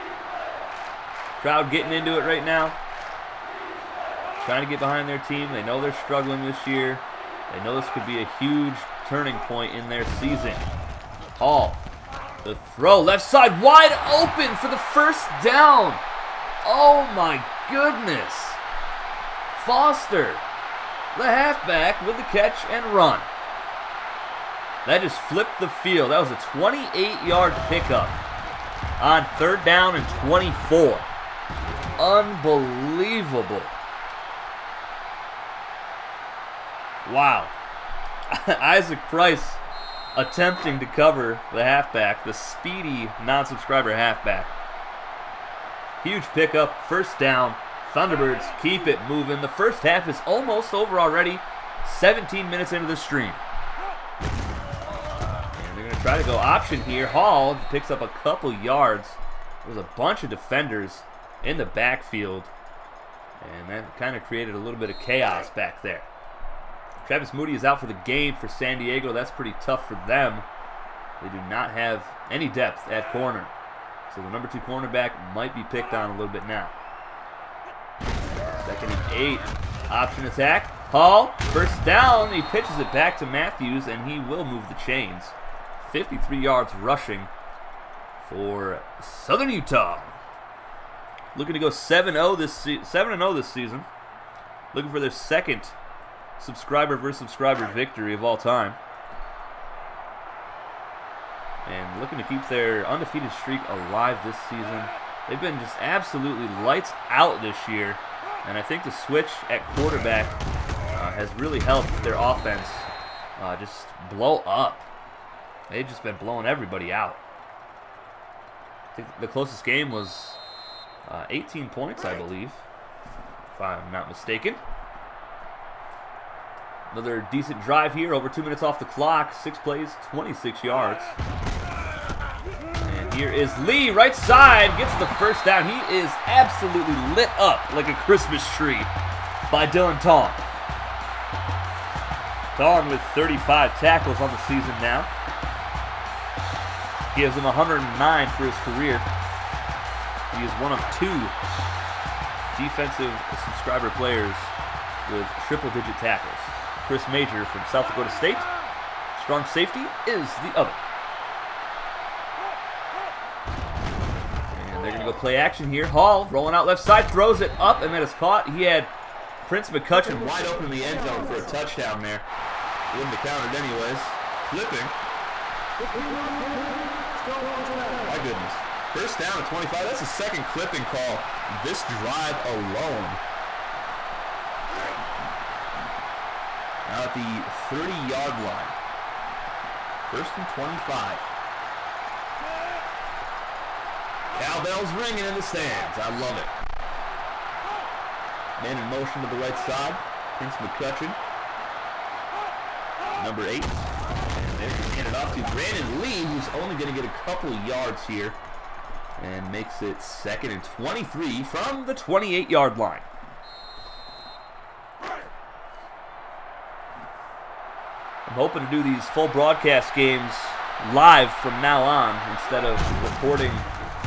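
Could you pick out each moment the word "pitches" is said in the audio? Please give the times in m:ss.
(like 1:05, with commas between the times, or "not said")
1:22.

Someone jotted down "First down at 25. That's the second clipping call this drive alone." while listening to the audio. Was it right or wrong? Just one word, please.
right.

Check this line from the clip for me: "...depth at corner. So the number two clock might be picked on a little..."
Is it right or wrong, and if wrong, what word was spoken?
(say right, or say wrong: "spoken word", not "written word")
wrong: "cornerback", not "clock".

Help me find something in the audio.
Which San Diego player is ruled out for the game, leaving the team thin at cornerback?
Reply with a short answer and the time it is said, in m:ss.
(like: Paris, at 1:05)
Travis Moody, at 1:07.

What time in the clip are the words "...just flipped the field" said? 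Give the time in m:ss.
0:25.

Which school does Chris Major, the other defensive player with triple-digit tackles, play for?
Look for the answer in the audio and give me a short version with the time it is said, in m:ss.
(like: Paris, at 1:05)
South Dakota State, at 2:37.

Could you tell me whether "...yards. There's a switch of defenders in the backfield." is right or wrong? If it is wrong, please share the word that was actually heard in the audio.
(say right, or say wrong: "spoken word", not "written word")
wrong: "bunch", not "switch".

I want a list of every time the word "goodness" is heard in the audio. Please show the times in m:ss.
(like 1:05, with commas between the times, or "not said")
0:17, 2:58.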